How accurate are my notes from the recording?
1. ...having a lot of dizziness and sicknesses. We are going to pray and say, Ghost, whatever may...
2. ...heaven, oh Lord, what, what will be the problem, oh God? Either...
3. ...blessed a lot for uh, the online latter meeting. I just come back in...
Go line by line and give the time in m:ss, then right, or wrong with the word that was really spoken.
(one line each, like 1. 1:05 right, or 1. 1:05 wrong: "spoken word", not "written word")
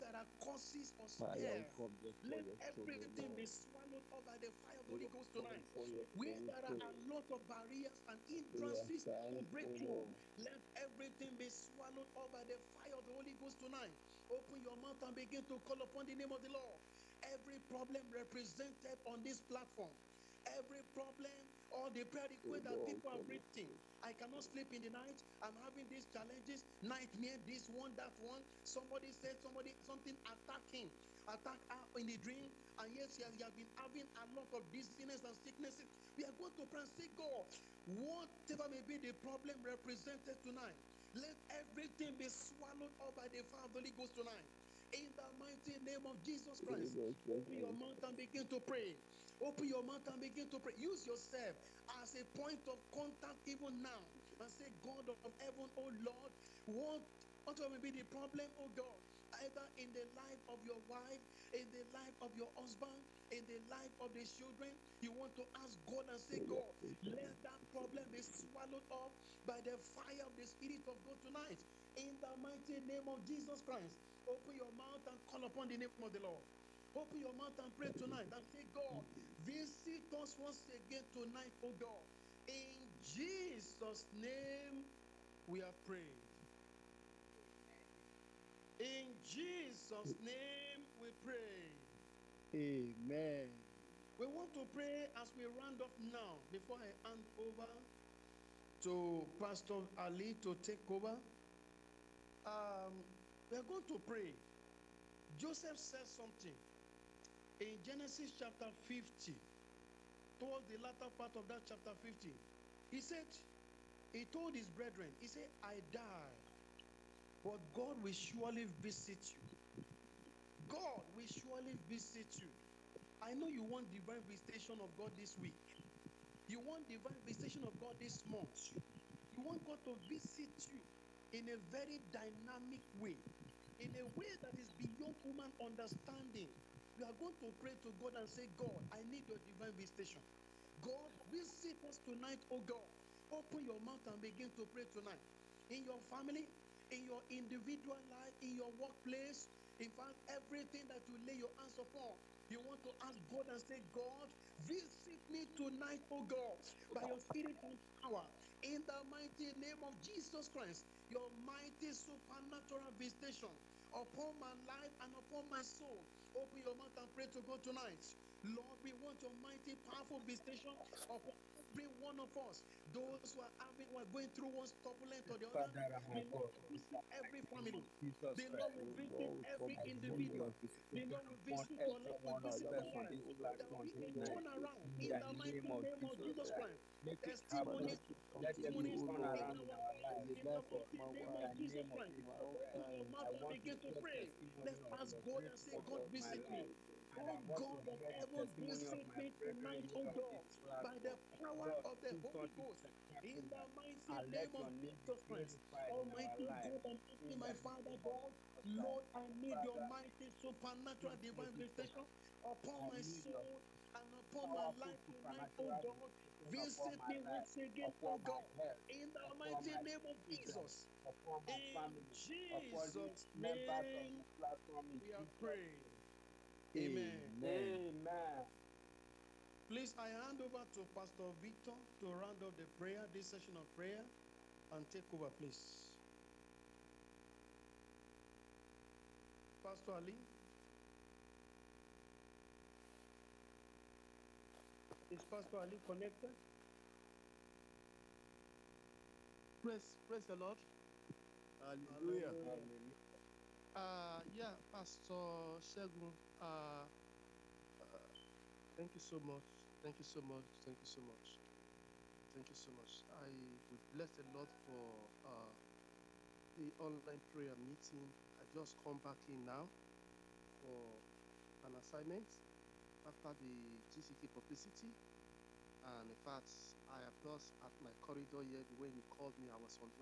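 1. 0:33 wrong: "God", not "Ghost"
2. 0:55 right
3. 4:23 wrong: "prayer", not "latter".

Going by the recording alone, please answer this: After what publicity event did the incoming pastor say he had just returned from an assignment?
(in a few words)
GCK publicity.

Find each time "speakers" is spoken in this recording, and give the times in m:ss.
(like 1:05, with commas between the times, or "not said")
not said.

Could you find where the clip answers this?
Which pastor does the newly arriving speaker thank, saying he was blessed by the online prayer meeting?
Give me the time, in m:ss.
4:14.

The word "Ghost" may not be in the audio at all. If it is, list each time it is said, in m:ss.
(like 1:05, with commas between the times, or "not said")
0:05, 0:13, 0:43, 3:22.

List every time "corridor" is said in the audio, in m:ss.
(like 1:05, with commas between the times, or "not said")
4:38.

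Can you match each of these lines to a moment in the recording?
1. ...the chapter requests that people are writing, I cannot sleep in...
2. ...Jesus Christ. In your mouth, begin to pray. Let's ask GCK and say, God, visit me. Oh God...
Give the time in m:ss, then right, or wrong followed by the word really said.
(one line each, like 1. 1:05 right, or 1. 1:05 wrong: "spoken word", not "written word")
1. 0:21 wrong: "prayer", not "chapter"
2. 3:11 wrong: "God", not "GCK".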